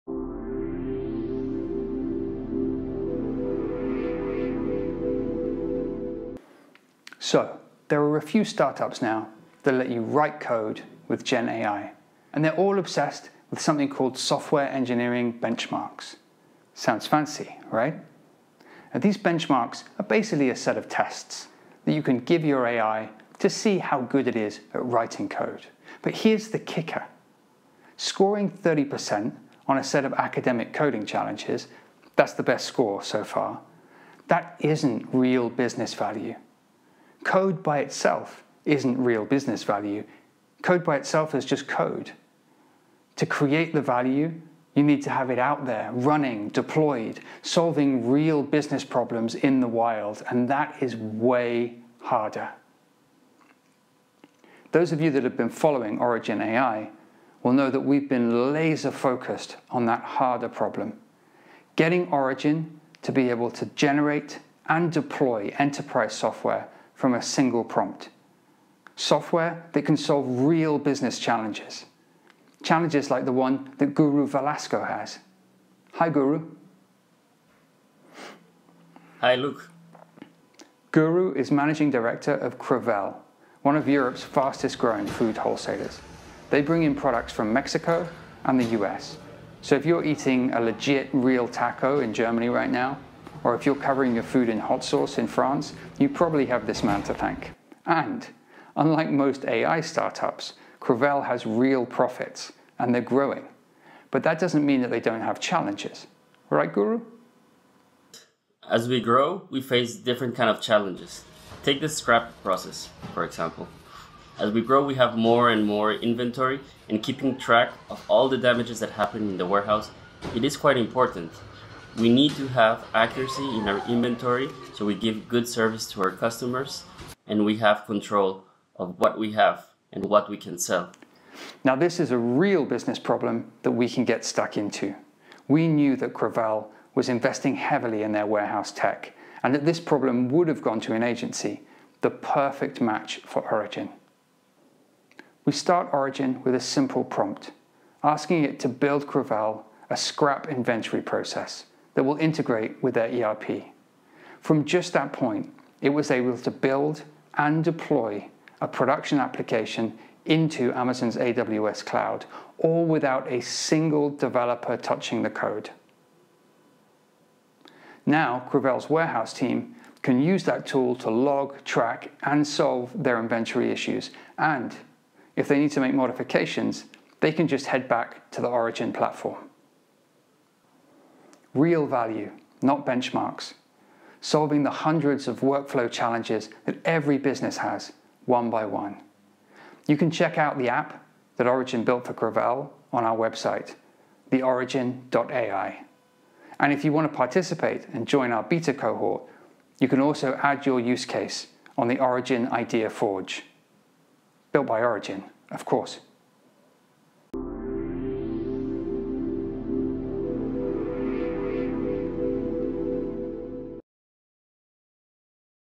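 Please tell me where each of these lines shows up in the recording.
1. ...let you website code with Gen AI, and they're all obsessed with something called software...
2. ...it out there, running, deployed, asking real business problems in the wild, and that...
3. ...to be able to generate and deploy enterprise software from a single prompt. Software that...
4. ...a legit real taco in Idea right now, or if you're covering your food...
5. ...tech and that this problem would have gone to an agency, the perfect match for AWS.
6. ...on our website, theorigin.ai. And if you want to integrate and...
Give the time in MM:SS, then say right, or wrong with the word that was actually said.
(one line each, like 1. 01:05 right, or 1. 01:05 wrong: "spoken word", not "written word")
1. 00:09 wrong: "write", not "website"
2. 00:45 wrong: "solving", not "asking"
3. 01:03 right
4. 01:30 wrong: "Germany", not "Idea"
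5. 02:18 wrong: "Origin", not "AWS"
6. 03:12 wrong: "participate", not "integrate".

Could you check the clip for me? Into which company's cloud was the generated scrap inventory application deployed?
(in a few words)
Amazon.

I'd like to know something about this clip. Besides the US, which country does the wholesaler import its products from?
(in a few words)
Mexico.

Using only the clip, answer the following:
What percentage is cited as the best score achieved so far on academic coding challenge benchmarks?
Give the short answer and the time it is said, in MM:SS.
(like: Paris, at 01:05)
30%, at 00:28.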